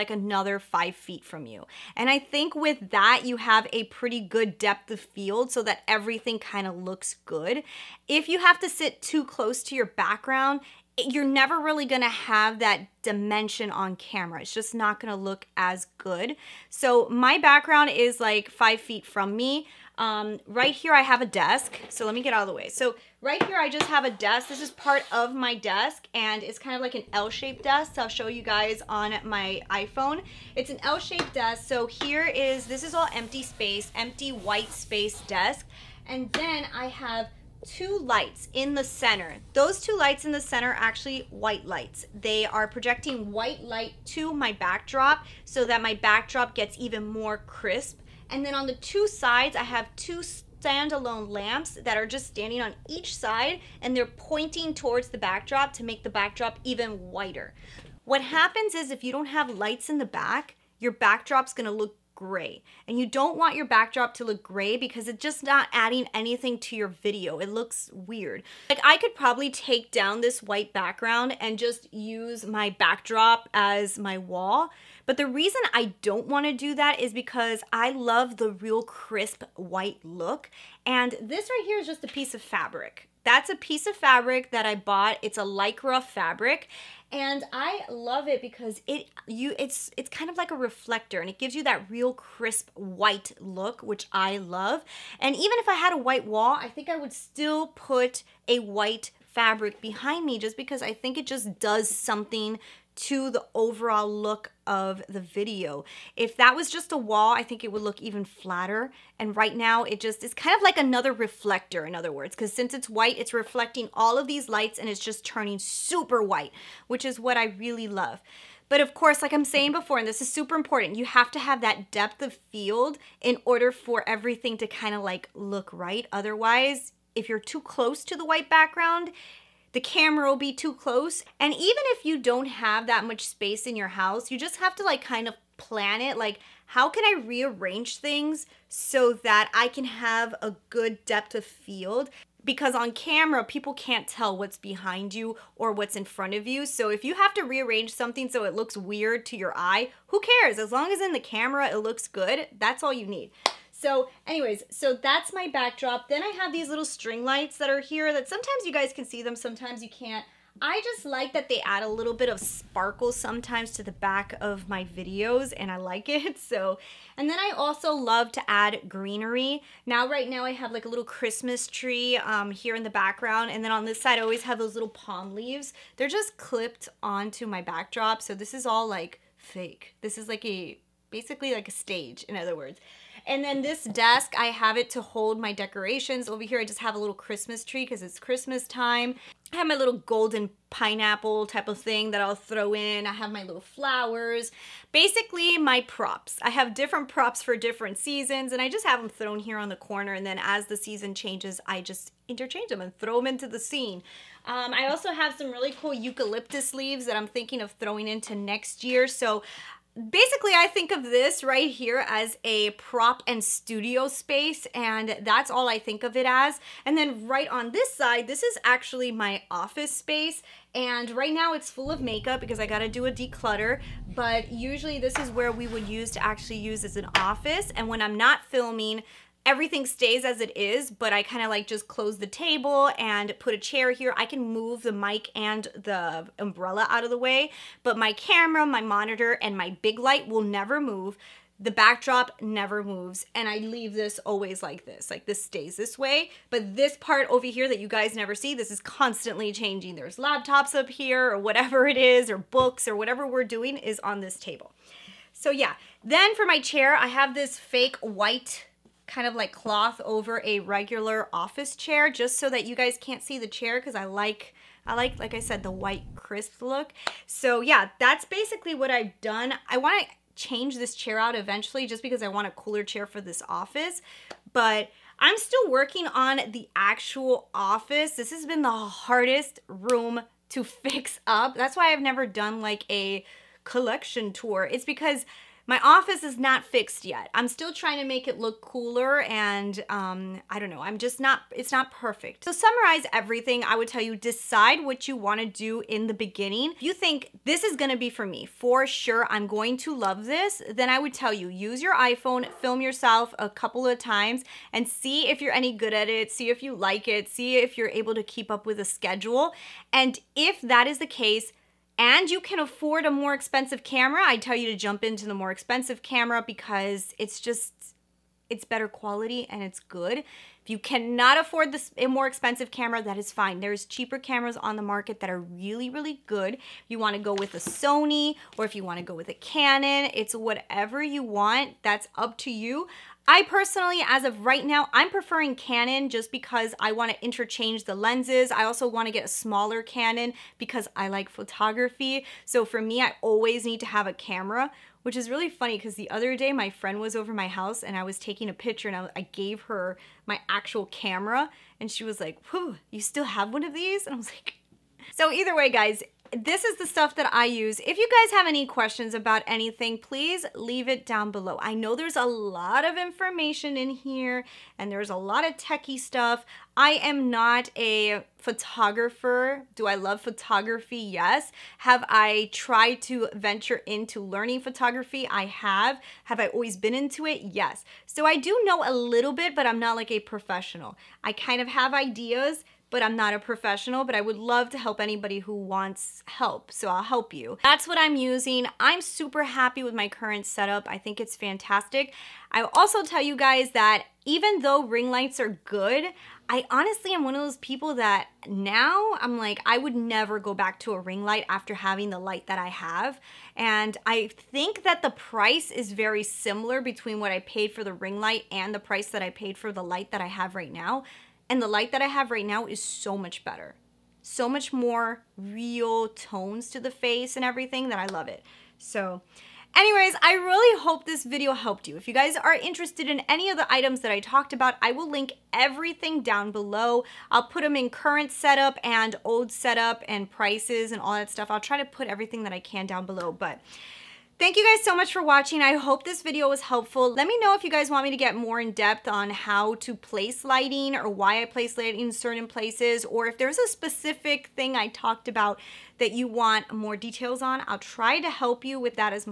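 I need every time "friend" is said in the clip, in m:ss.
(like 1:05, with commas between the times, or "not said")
5:46.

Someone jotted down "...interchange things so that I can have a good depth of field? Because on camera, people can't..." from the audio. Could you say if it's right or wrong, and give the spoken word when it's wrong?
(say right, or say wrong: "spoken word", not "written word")
wrong: "rearrange", not "interchange".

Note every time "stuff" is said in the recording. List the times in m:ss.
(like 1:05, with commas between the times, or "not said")
5:56, 6:05, 7:11.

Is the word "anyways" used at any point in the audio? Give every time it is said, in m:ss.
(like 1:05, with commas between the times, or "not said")
2:34, 6:59.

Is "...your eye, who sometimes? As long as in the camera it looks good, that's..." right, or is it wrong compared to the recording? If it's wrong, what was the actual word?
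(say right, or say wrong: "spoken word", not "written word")
wrong: "cares", not "sometimes".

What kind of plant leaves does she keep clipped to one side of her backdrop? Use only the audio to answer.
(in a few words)
Palm leaves.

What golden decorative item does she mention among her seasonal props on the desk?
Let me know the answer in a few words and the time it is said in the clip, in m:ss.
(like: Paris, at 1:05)
Pineapple, at 3:09.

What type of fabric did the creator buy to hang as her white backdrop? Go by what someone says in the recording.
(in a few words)
Lycra.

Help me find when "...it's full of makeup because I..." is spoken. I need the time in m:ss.
3:41.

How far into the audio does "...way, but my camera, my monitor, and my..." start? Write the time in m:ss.
3:57.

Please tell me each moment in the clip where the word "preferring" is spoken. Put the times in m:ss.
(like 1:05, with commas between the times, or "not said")
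5:35.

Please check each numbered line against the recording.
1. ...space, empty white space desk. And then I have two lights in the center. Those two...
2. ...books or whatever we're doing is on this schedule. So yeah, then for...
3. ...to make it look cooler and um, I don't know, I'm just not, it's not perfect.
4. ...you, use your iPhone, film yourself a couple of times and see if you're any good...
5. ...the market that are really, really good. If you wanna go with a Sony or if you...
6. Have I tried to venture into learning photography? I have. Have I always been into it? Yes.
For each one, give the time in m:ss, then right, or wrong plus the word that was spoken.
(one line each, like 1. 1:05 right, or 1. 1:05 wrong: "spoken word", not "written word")
1. 0:33 right
2. 4:12 wrong: "table", not "schedule"
3. 4:47 right
4. 5:01 right
5. 5:24 right
6. 6:11 right.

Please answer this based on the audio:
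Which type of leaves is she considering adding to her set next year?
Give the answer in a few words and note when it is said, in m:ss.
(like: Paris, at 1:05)
Eucalyptus, at 3:25.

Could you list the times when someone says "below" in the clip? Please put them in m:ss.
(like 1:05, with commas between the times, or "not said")
6:01, 7:06, 7:13.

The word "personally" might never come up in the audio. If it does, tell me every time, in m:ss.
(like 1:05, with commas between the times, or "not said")
5:33.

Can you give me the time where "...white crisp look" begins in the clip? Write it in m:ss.
4:25.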